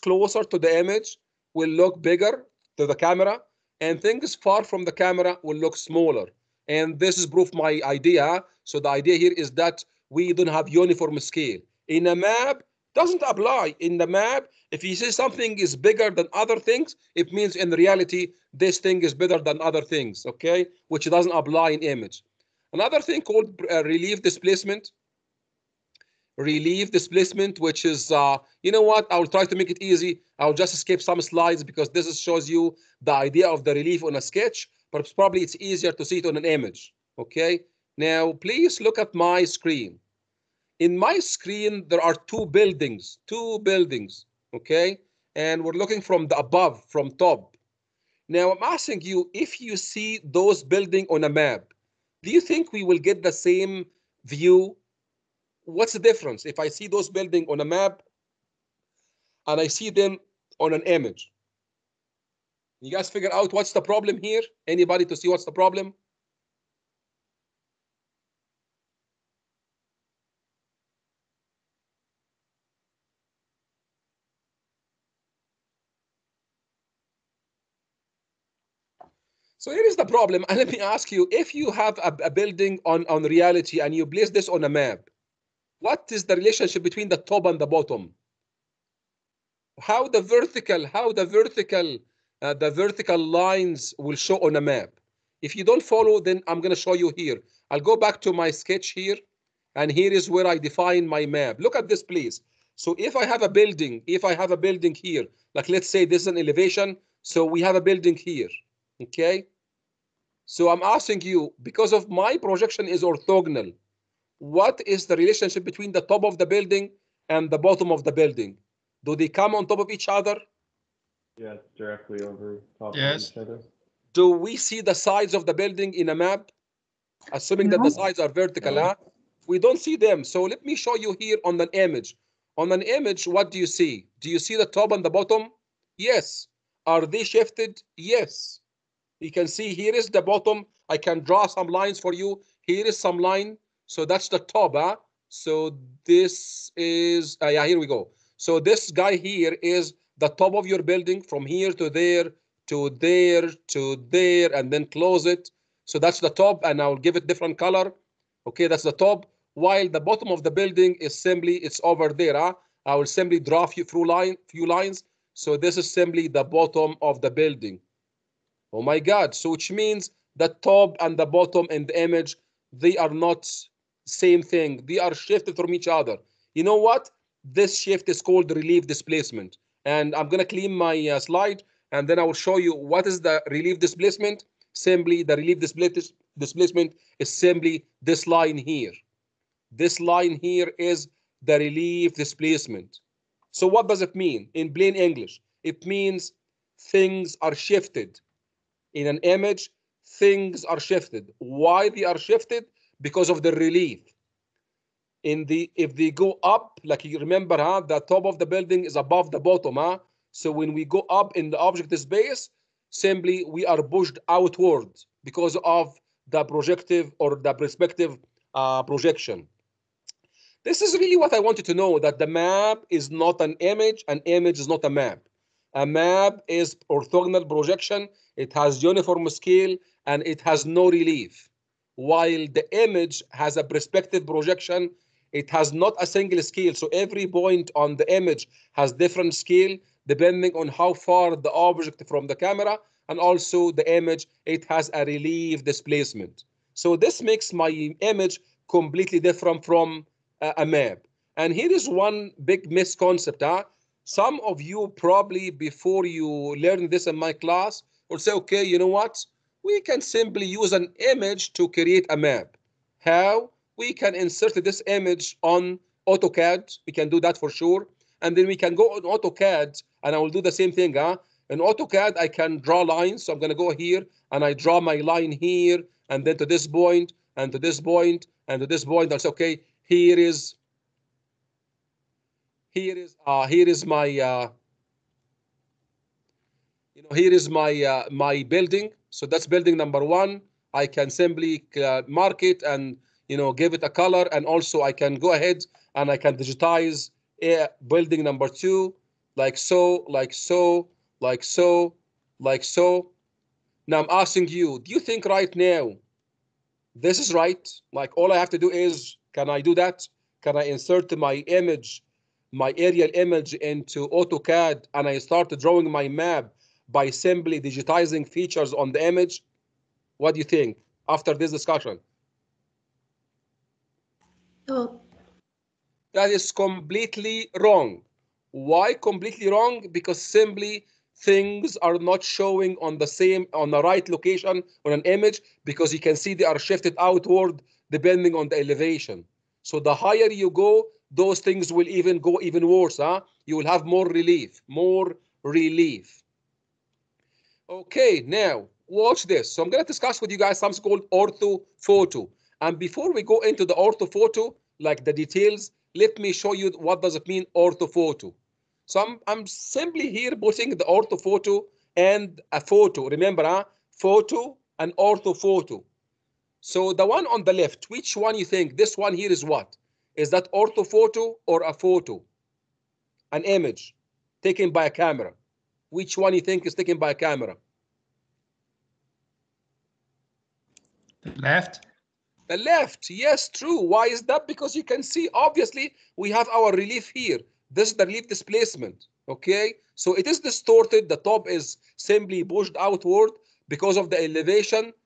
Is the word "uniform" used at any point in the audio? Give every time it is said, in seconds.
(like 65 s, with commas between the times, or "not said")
10 s, 228 s.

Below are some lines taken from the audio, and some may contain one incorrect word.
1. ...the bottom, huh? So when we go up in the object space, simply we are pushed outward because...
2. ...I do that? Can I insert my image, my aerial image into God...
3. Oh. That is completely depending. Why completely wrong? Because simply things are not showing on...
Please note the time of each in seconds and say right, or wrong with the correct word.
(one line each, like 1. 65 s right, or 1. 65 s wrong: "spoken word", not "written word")
1. 209 s right
2. 309 s wrong: "AutoCAD", not "God"
3. 324 s wrong: "wrong", not "depending".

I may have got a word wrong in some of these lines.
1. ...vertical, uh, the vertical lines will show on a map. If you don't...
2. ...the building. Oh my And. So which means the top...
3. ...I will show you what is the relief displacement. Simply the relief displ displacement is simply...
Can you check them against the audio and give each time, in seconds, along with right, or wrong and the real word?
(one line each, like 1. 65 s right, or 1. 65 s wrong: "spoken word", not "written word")
1. 91 s right
2. 167 s wrong: "God", not "And"
3. 182 s right.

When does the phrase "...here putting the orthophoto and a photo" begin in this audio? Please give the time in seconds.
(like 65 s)
360 s.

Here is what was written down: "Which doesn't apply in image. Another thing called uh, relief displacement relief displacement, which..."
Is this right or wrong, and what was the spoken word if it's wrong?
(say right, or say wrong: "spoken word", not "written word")
right.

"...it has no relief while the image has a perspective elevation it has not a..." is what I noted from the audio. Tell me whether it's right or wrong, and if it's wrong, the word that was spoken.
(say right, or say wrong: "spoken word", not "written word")
wrong: "projection", not "elevation".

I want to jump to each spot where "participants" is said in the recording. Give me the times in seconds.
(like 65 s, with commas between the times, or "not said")
not said.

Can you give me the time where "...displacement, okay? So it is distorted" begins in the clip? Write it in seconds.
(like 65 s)
388 s.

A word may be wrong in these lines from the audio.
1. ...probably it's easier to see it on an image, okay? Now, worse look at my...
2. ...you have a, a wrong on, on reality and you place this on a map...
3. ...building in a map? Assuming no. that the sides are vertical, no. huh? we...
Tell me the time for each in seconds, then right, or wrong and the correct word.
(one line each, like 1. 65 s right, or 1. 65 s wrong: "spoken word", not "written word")
1. 35 s wrong: "please", not "worse"
2. 81 s wrong: "building", not "wrong"
3. 125 s right.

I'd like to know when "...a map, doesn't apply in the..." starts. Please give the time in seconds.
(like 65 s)
12 s.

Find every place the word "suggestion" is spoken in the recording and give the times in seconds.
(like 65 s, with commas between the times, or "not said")
not said.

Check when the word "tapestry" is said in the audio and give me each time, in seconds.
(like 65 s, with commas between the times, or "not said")
not said.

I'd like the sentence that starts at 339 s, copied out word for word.
So the higher you go, those things will even go even worse.